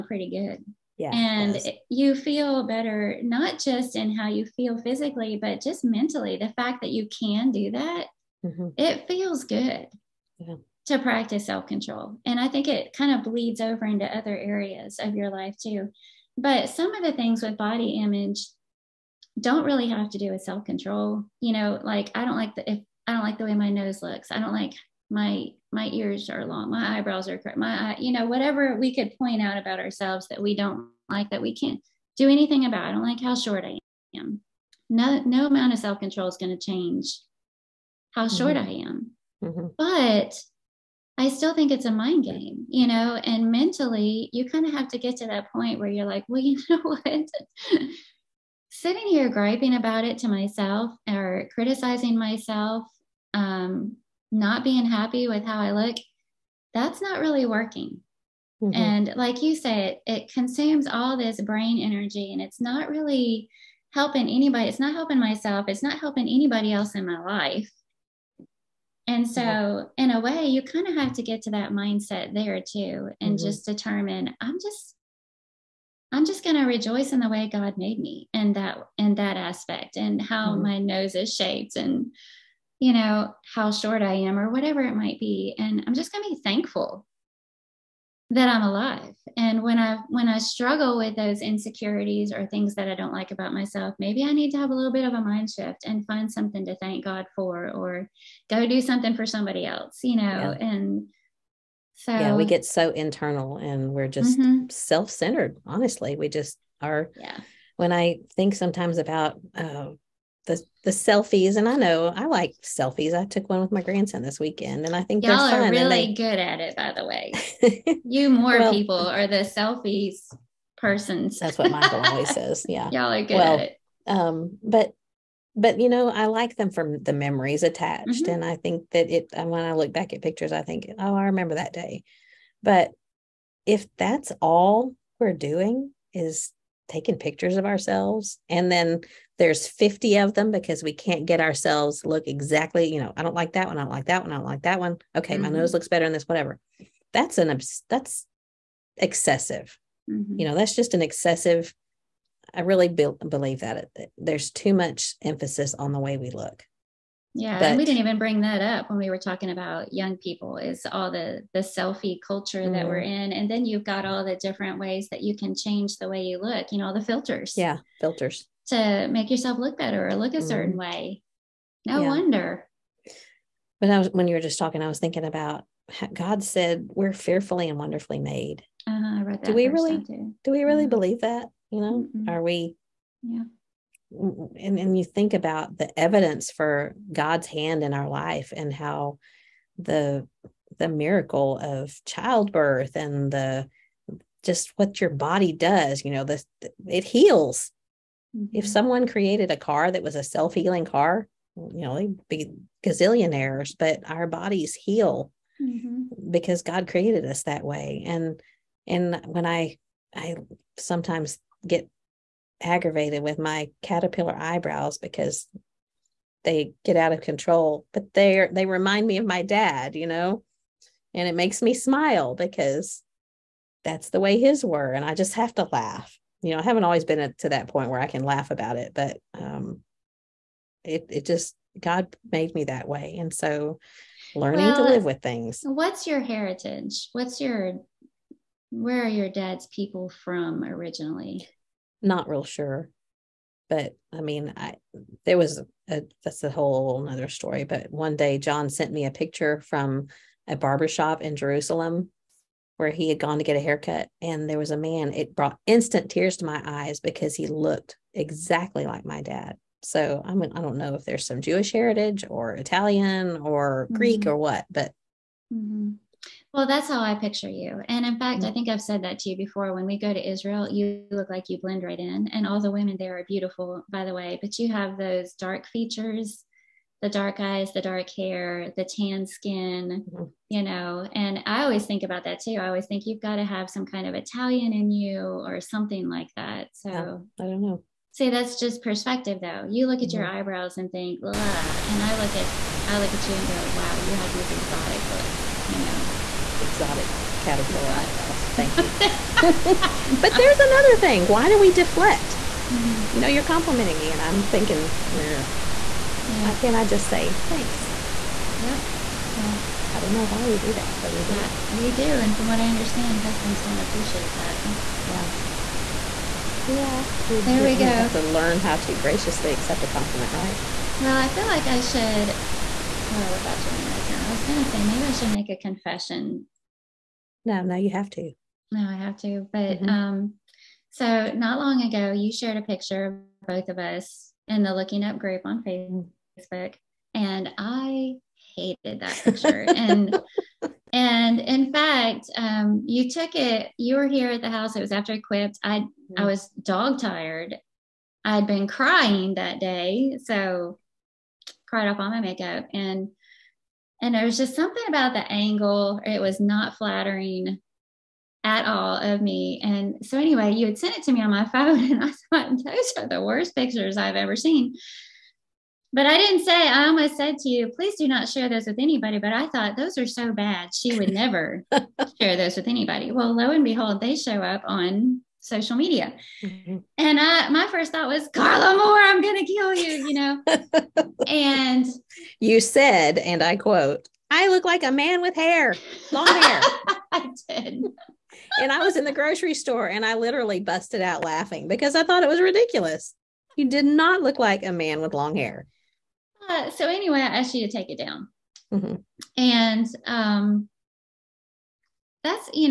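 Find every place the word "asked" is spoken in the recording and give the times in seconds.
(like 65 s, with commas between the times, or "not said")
397 s.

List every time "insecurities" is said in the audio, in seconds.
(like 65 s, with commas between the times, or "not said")
91 s.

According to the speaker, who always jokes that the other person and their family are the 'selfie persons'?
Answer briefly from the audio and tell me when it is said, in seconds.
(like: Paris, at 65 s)
Michael, at 121 s.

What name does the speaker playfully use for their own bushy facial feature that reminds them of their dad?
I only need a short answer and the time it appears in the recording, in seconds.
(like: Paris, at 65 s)
Caterpillar eyebrows, at 213 s.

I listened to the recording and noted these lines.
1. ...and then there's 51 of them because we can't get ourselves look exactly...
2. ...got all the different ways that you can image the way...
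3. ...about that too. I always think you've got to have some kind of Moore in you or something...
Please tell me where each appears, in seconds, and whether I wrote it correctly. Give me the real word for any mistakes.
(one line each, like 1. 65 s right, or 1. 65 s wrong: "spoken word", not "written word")
1. 138 s wrong: "50", not "51"
2. 163 s wrong: "change", not "image"
3. 282 s wrong: "Italian", not "Moore".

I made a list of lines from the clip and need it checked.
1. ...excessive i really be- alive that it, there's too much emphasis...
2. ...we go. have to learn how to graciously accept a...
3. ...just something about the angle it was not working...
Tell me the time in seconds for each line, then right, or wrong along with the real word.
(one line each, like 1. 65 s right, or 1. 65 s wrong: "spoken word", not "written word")
1. 151 s wrong: "believe", not "alive"
2. 317 s right
3. 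354 s wrong: "flattering", not "working".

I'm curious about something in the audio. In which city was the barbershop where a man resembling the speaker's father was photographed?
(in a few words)
Jerusalem.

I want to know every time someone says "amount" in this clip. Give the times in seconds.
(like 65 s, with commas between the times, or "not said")
35 s.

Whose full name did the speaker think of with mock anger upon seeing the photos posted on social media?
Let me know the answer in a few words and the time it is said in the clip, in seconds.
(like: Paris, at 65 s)
Carla Moore, at 378 s.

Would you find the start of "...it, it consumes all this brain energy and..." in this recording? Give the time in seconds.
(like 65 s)
60 s.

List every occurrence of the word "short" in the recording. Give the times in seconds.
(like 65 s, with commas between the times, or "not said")
33 s, 38 s, 83 s.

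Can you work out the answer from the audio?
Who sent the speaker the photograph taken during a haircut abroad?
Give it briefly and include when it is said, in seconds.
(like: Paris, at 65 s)
John, at 248 s.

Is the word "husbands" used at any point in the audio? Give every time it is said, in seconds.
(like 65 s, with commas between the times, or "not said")
313 s.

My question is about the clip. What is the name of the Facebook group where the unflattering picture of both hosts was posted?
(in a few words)
Looking Up.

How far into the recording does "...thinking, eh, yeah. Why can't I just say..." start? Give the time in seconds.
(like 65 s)
304 s.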